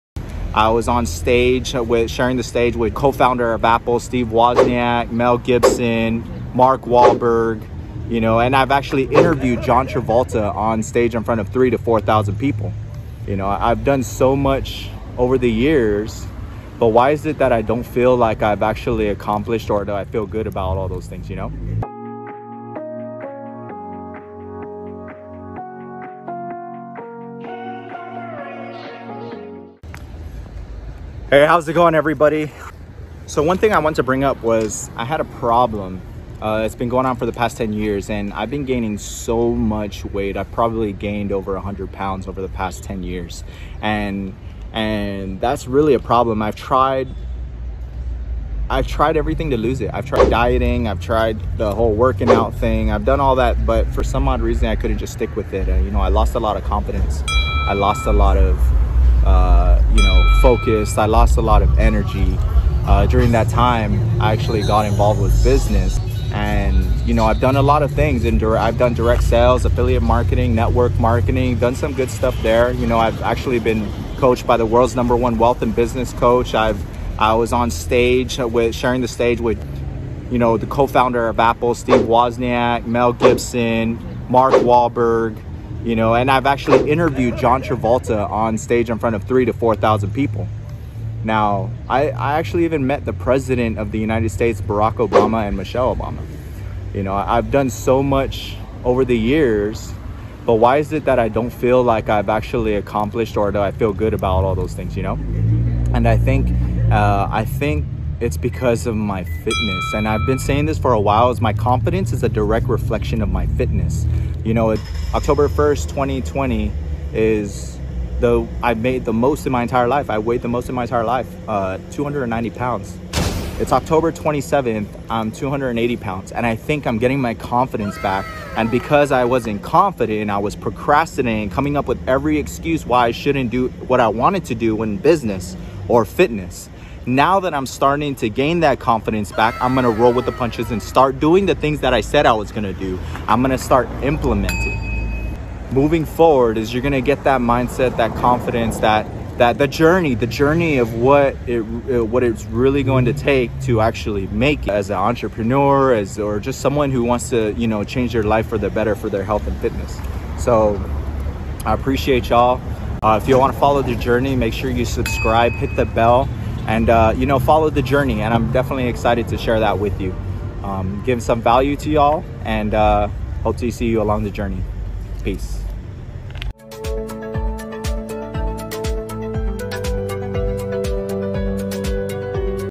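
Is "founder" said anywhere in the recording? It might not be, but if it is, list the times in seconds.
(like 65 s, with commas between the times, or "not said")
2 s, 80 s.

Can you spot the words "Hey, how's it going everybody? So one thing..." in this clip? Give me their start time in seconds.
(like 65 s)
31 s.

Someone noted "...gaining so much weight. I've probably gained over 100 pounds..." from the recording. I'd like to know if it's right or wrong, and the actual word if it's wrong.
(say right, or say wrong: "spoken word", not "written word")
right.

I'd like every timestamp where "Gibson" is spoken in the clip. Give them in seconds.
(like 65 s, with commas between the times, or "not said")
5 s, 83 s.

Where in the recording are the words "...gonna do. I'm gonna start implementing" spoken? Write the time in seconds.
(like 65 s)
142 s.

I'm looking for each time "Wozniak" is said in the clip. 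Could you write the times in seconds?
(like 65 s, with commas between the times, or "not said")
4 s, 82 s.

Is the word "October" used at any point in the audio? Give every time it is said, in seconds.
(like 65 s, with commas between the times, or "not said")
115 s, 123 s.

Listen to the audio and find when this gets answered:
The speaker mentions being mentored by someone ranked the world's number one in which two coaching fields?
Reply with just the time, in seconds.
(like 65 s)
75 s.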